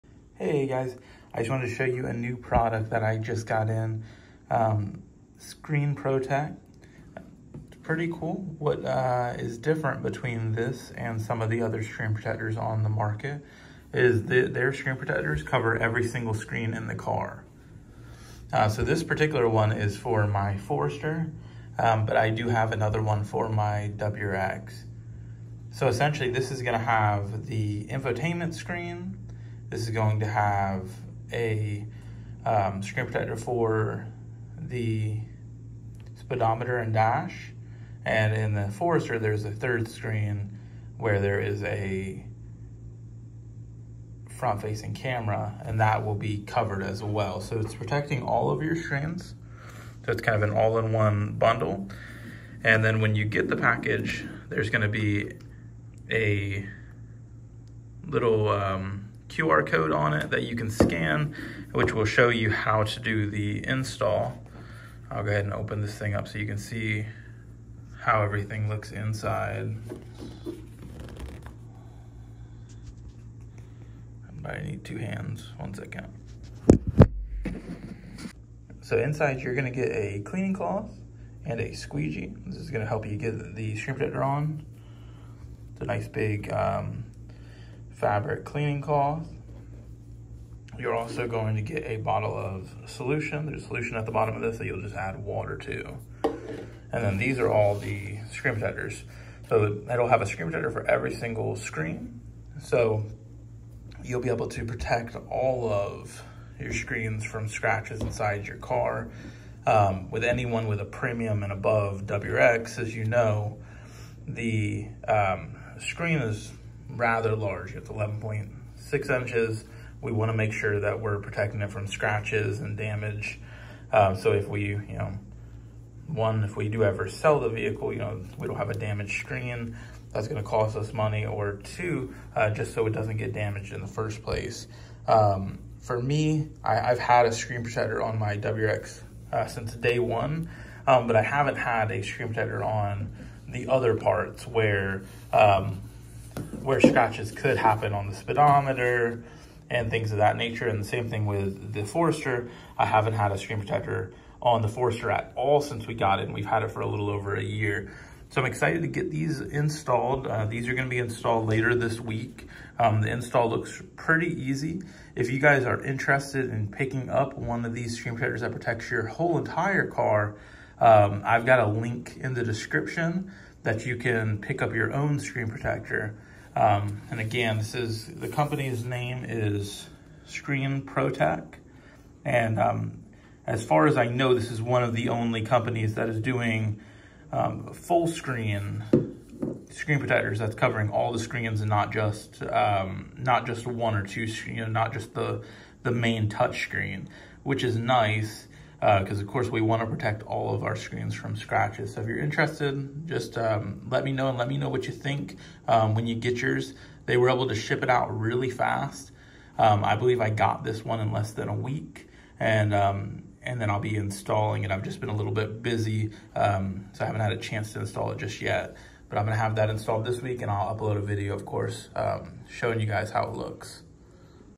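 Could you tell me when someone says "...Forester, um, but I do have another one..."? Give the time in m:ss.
0:20.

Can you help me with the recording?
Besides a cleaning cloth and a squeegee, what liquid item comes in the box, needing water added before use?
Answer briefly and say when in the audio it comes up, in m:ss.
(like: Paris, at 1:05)
a bottle of solution, at 1:31.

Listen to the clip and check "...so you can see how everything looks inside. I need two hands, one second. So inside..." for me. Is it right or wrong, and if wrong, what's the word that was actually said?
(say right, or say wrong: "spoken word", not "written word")
right.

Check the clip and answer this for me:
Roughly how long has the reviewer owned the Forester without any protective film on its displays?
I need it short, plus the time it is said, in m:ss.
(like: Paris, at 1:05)
a little over a year, at 2:36.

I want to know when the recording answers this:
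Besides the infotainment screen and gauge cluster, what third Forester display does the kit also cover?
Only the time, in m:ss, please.
0:44.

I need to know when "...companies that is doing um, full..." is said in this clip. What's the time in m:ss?
3:05.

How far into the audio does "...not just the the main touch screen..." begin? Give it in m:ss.
3:14.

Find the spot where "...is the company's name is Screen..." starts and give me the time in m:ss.
2:57.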